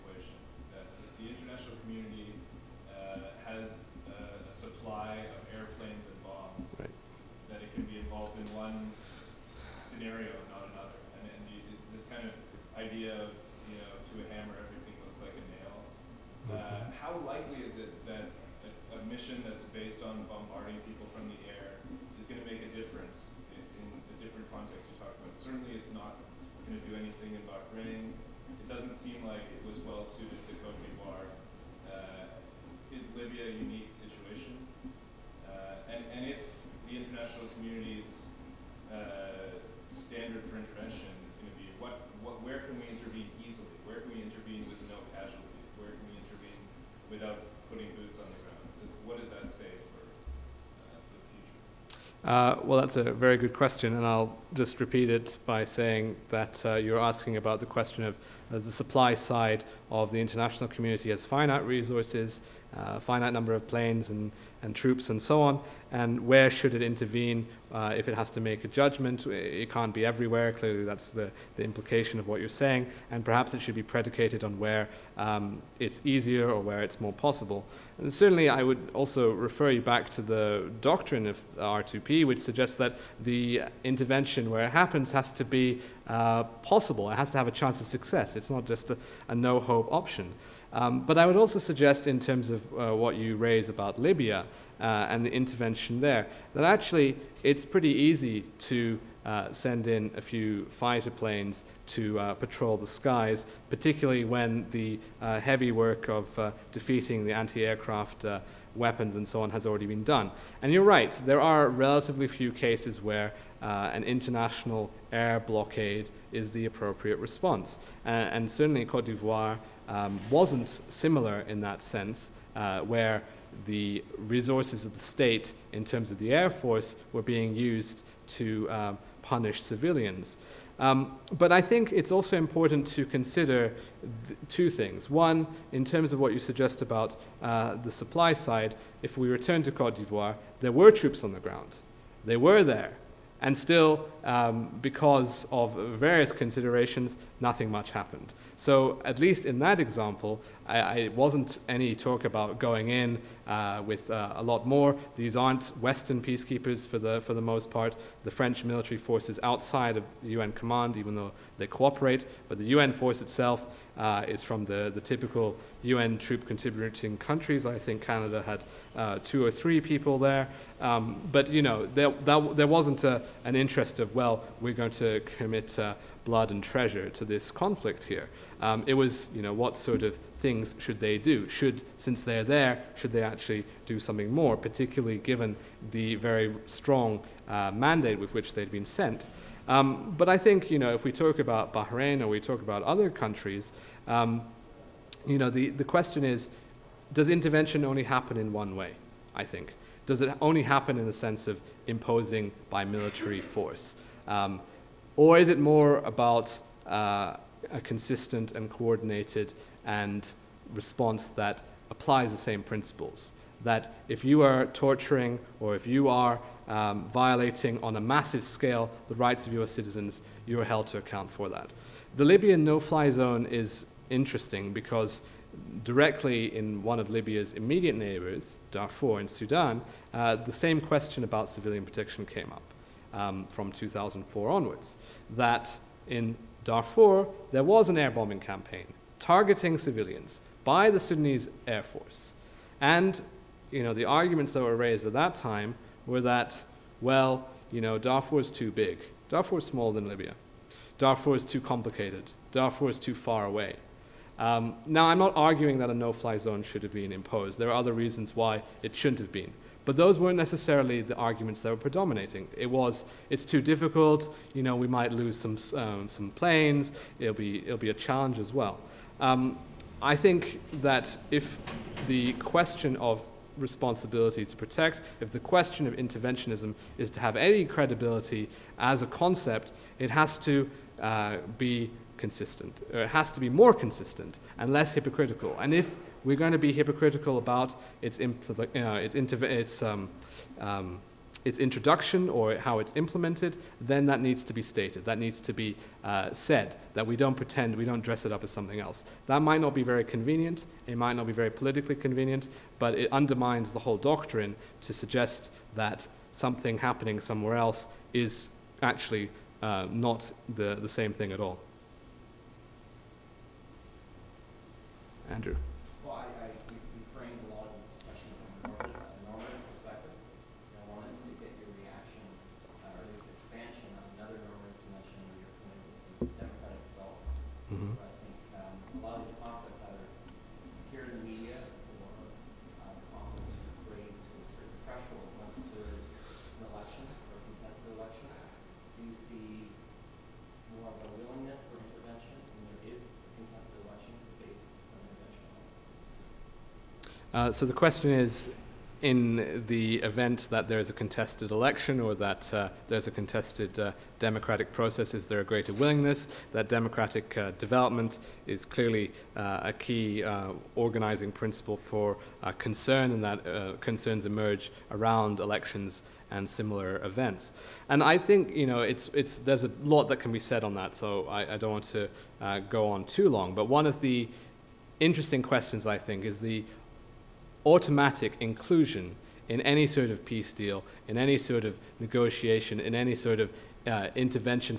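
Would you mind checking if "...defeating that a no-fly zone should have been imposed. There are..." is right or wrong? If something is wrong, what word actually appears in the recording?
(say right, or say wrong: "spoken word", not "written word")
wrong: "arguing", not "defeating".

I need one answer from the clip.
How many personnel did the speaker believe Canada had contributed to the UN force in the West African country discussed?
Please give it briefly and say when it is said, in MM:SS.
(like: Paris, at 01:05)
2 or 3, at 02:49.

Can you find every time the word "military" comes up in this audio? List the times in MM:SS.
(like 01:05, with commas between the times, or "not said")
02:38, 03:22.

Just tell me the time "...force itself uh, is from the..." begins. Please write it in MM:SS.
02:42.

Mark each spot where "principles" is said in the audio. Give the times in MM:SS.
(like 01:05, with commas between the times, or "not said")
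03:32, 06:01.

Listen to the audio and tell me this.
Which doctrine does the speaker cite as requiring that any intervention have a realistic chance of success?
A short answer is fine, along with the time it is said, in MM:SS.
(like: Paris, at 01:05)
R2P, at 01:21.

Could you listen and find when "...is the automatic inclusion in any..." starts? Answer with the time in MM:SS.
06:16.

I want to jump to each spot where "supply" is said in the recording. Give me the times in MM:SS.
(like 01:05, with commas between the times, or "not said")
00:58, 02:17.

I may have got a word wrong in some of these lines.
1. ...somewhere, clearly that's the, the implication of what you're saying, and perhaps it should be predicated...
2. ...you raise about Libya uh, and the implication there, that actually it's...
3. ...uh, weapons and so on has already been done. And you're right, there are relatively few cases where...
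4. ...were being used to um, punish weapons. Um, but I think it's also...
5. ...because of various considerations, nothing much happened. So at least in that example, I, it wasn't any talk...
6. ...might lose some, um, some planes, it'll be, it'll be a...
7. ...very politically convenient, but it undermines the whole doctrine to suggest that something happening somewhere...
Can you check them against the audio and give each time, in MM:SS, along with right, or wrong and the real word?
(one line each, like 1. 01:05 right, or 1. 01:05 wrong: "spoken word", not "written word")
1. 01:10 wrong: "everywhere", not "somewhere"
2. 01:33 wrong: "intervention", not "implication"
3. 01:48 right
4. 02:07 wrong: "civilians", not "weapons"
5. 02:24 right
6. 04:24 right
7. 05:01 right.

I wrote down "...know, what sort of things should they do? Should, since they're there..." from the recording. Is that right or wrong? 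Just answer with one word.
right.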